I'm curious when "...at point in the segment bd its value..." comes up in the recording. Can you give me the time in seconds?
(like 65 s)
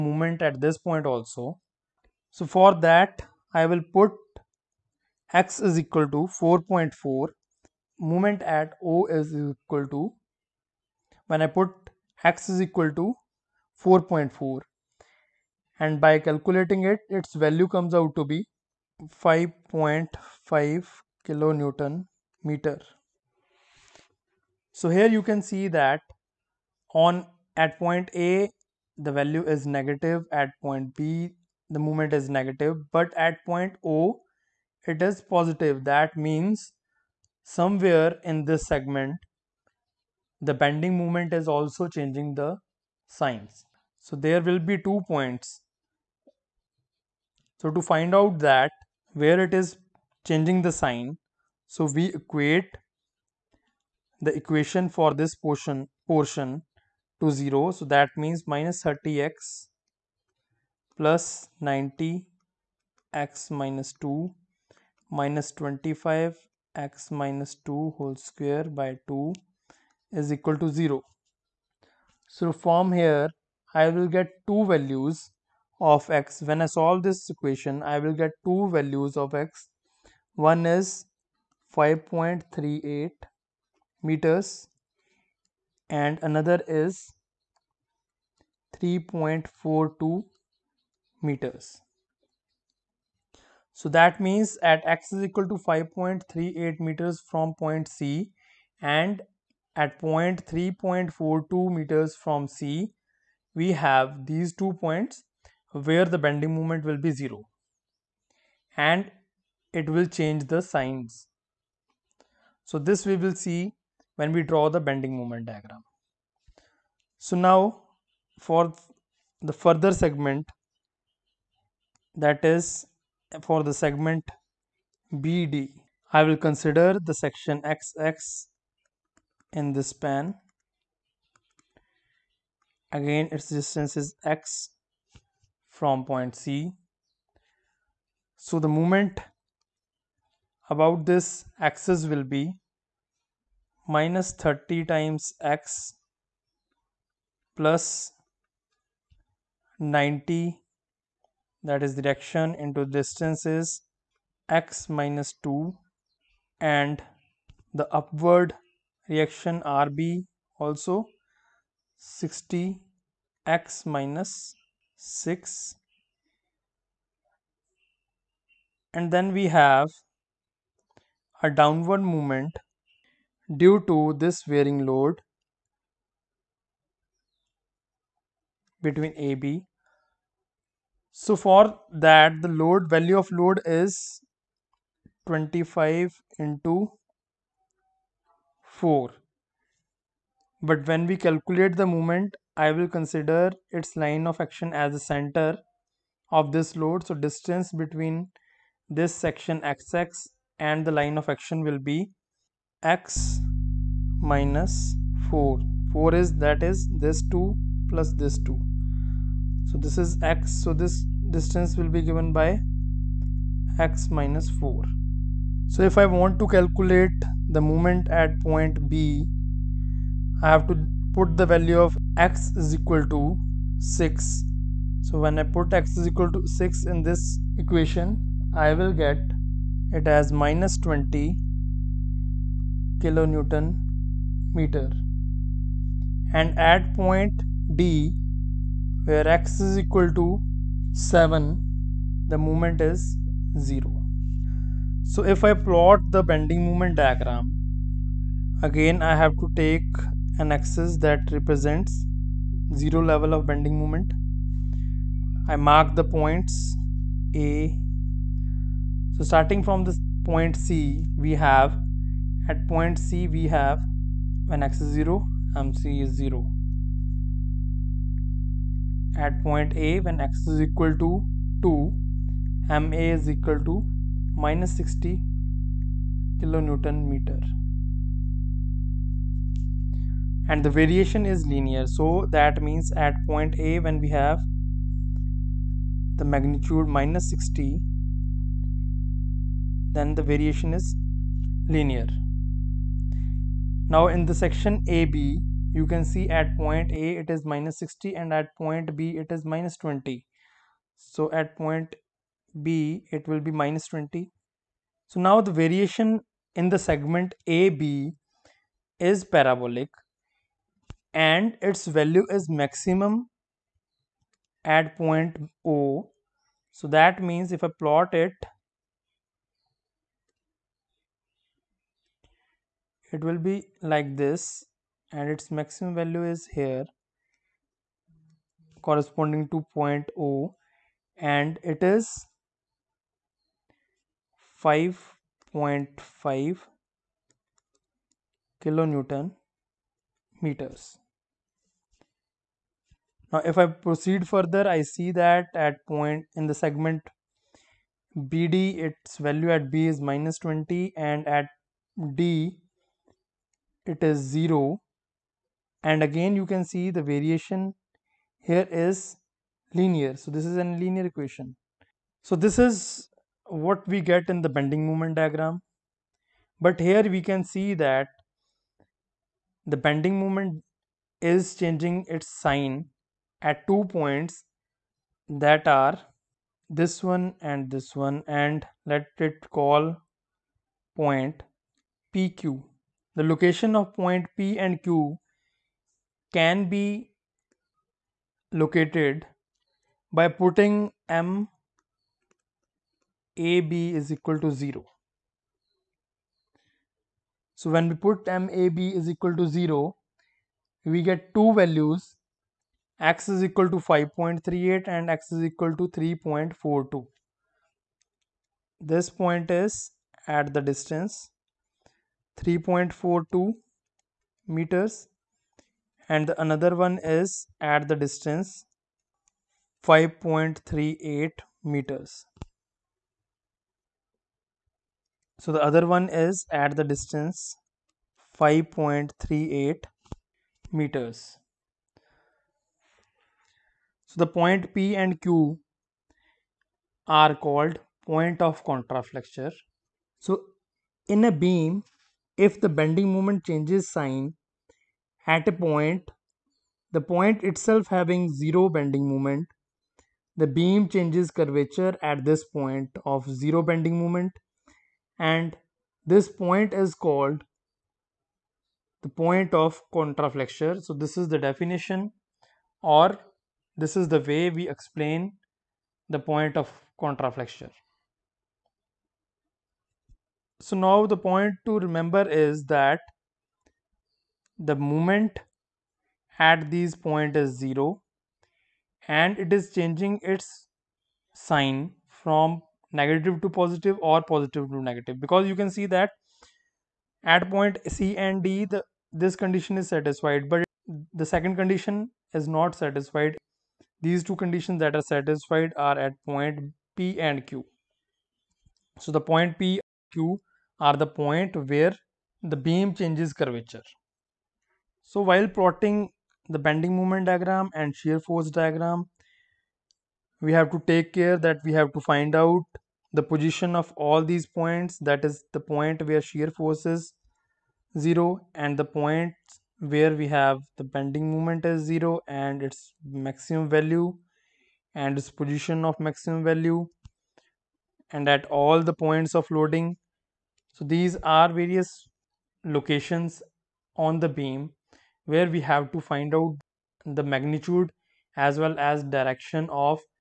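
345 s.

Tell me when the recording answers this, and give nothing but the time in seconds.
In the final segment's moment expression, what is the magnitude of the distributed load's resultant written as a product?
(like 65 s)
185 s.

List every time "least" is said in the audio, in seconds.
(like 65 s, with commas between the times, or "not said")
not said.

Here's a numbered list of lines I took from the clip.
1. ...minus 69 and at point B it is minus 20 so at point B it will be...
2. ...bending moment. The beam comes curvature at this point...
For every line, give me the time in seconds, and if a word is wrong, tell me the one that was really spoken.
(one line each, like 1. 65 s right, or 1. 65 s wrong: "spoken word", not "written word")
1. 297 s wrong: "60", not "69"
2. 448 s wrong: "changes", not "comes".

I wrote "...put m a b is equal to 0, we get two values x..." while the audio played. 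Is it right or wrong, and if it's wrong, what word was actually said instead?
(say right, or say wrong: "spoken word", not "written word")
right.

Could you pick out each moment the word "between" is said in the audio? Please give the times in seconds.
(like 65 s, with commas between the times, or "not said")
178 s, 197 s.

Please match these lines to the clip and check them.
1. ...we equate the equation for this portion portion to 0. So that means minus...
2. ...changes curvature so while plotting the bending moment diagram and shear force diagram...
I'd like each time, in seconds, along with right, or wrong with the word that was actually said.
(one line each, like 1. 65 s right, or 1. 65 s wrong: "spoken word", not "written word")
1. 51 s right
2. 502 s right.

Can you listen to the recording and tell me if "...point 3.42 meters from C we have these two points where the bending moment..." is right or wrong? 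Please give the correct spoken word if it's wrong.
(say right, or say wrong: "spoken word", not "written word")
right.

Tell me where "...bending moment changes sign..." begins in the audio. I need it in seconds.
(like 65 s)
442 s.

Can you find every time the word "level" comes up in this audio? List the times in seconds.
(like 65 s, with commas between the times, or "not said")
253 s.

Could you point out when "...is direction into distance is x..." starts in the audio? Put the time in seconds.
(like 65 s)
151 s.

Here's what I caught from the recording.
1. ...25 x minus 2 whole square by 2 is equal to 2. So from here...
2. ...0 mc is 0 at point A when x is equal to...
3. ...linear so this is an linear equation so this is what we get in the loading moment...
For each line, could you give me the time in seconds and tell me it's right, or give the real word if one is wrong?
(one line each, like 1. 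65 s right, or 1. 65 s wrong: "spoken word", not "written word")
1. 65 s wrong: "0", not "2"
2. 264 s right
3. 359 s wrong: "bending", not "loading".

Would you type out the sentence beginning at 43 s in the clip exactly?
So there will be two points.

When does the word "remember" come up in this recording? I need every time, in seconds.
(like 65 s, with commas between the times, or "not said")
471 s.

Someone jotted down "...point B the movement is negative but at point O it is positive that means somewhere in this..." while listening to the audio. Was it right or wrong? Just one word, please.
right.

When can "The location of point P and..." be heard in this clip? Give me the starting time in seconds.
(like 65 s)
383 s.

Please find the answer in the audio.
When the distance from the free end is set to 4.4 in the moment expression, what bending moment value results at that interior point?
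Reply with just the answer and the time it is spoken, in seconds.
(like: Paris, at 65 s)
5.5 kN·m, at 19 s.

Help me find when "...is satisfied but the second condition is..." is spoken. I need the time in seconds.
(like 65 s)
489 s.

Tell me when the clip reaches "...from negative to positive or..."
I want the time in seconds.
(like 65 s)
482 s.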